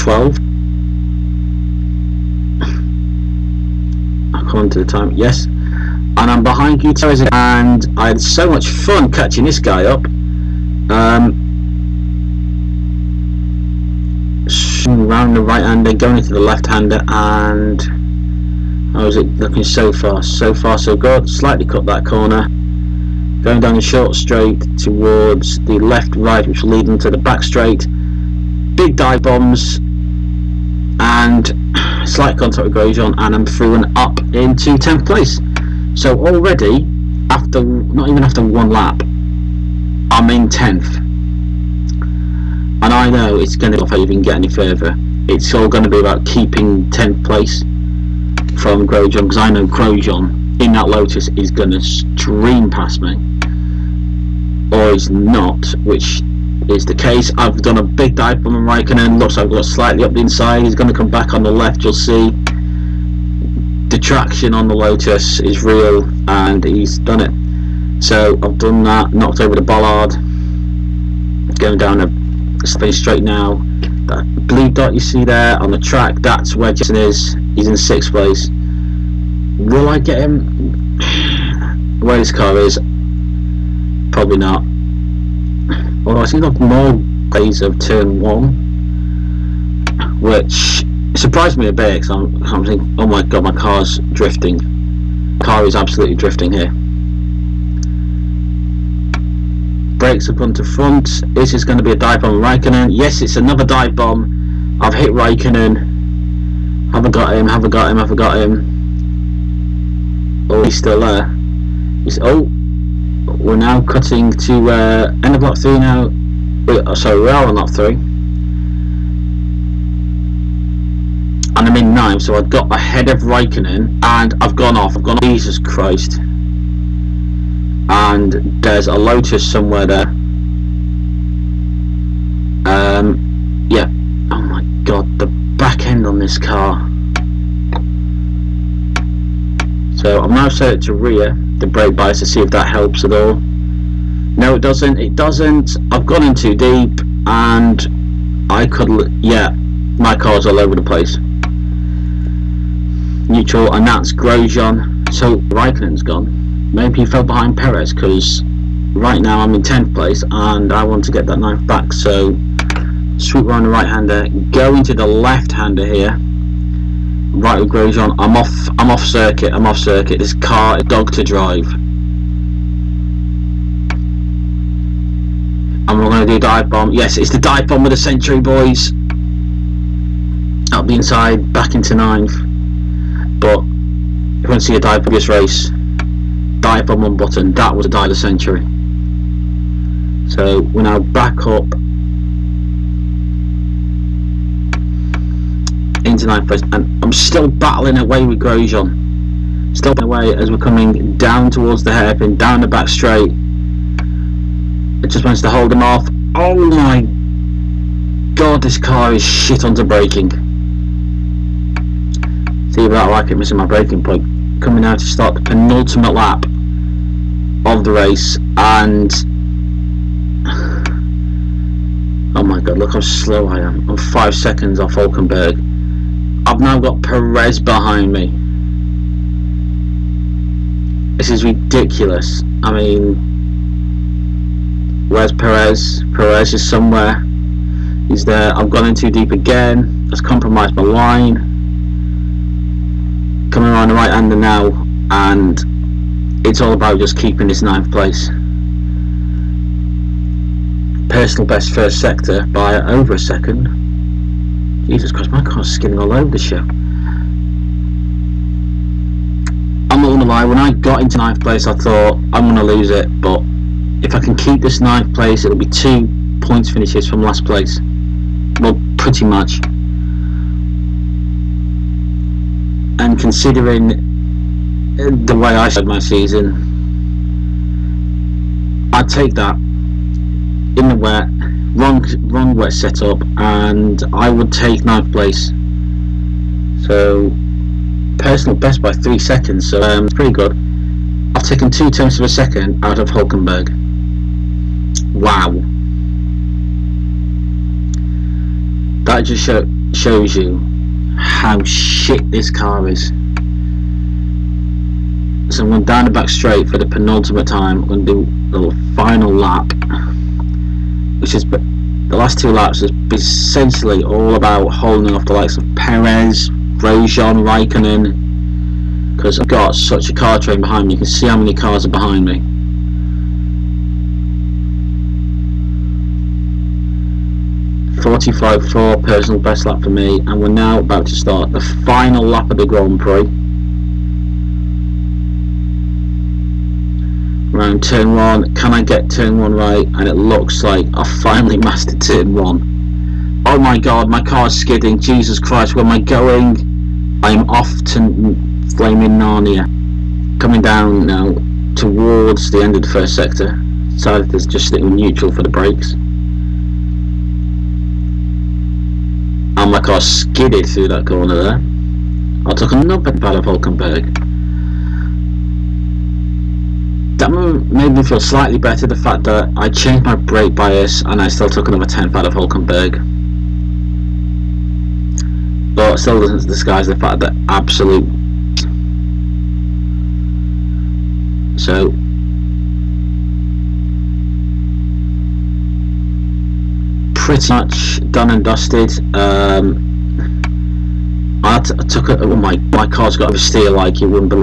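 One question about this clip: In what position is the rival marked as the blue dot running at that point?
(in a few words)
Sixth.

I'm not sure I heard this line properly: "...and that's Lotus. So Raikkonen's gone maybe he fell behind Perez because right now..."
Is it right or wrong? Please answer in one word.
wrong.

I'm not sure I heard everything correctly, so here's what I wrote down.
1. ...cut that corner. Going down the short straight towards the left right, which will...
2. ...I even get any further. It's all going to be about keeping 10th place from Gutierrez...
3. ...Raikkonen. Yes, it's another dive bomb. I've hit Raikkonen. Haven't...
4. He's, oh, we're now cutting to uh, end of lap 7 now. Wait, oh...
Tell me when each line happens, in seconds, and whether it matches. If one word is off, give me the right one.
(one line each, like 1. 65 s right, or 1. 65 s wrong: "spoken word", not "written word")
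1. 21 s right
2. 43 s wrong: "Grosjean", not "Gutierrez"
3. 102 s right
4. 112 s wrong: "3", not "7".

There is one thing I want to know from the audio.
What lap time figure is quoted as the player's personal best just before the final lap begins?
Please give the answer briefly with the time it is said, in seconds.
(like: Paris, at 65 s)
45.4, at 327 s.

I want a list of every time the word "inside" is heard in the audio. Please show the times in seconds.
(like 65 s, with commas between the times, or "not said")
60 s, 180 s.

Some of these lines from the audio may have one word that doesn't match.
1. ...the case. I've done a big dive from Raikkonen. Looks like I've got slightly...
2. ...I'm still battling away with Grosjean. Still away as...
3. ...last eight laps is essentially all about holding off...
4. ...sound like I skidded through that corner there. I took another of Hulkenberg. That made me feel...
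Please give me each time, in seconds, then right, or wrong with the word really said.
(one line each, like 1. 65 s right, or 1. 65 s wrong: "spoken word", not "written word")
1. 56 s right
2. 197 s right
3. 312 s wrong: "two", not "eight"
4. 359 s right.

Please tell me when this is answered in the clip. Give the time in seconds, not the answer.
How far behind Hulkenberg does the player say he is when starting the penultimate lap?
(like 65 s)
223 s.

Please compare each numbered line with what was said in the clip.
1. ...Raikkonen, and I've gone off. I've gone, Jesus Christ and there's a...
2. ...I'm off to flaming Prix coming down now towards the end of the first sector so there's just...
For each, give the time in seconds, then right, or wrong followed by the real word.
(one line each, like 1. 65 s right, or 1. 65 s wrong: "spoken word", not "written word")
1. 123 s right
2. 347 s wrong: "Narnia", not "Prix".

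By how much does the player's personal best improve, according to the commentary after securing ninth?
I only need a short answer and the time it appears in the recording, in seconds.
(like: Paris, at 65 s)
3 seconds, at 288 s.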